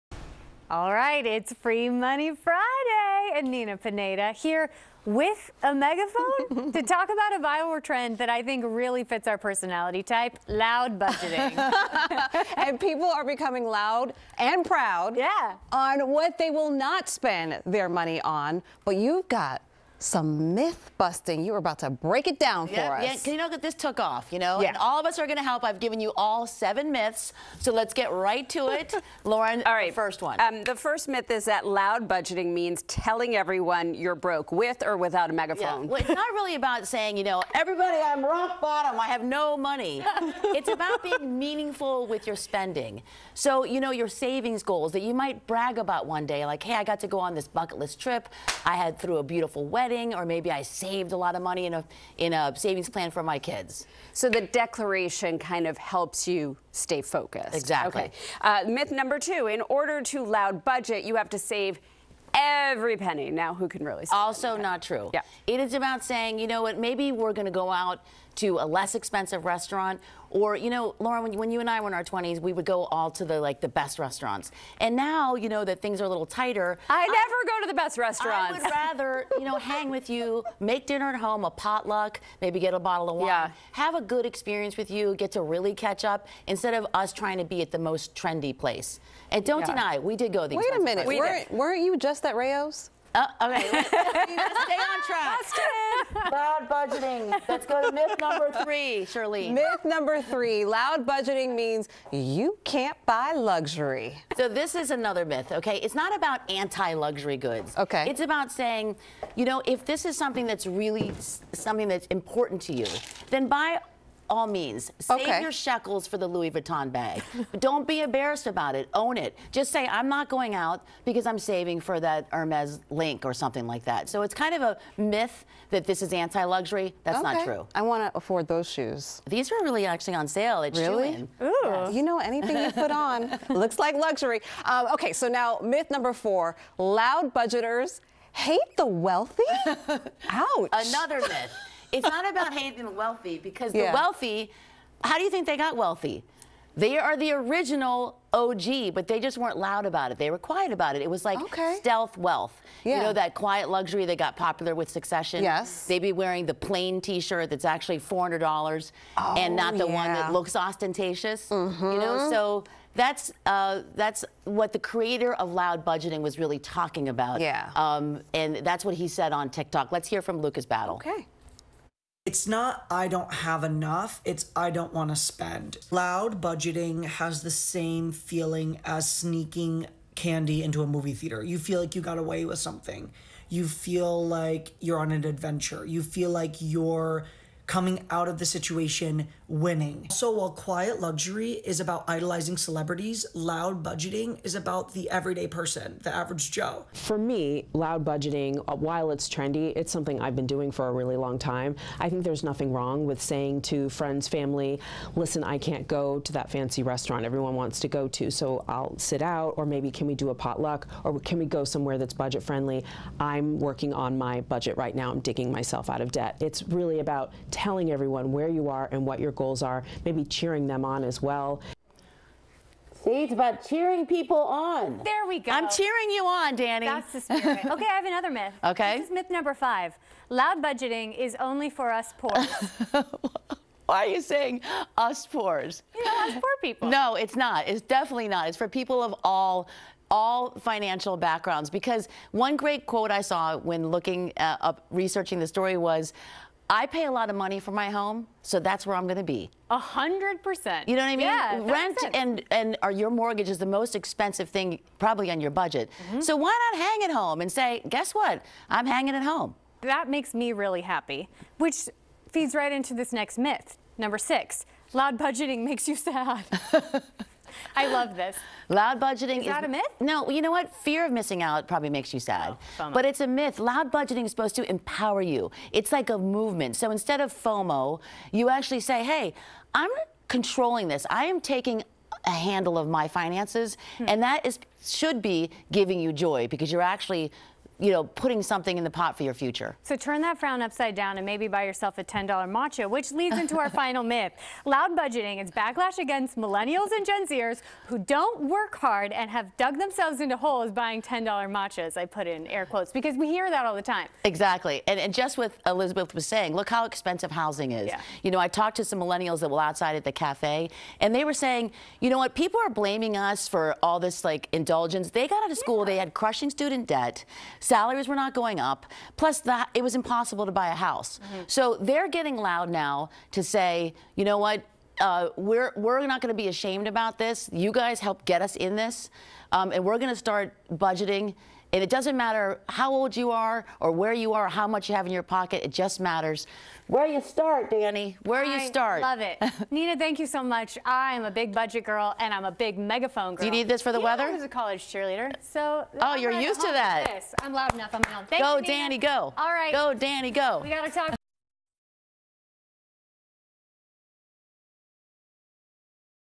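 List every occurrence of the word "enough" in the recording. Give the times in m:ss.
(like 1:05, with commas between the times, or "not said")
2:53, 5:47.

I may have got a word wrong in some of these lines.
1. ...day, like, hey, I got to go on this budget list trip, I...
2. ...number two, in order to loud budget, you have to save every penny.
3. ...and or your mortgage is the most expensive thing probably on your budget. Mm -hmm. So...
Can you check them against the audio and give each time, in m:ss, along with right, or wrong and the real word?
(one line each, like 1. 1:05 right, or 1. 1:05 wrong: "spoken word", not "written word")
1. 0:46 wrong: "bucket", not "budget"
2. 0:58 right
3. 4:12 right.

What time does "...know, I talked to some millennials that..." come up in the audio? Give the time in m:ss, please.
5:08.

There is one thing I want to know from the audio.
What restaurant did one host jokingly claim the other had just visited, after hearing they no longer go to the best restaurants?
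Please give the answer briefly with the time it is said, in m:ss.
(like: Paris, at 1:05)
Rayo's, at 1:32.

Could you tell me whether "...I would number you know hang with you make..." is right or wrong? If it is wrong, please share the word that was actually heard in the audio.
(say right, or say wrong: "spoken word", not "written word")
wrong: "rather", not "number".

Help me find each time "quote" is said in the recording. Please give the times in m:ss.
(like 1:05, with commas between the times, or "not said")
4:02, 5:02.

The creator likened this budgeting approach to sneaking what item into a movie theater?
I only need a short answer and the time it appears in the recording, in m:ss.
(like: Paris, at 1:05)
candy, at 3:00.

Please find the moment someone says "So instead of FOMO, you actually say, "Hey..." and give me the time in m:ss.
4:36.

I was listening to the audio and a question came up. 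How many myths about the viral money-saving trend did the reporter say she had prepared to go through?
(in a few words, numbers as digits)
7.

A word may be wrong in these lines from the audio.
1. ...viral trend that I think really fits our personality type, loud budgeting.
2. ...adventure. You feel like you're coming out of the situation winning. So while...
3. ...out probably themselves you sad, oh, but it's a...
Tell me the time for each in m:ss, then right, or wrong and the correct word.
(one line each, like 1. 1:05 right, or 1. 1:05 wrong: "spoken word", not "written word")
1. 0:07 right
2. 3:05 right
3. 4:31 wrong: "makes", not "themselves".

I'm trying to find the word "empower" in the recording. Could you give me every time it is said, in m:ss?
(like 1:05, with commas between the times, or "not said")
4:34.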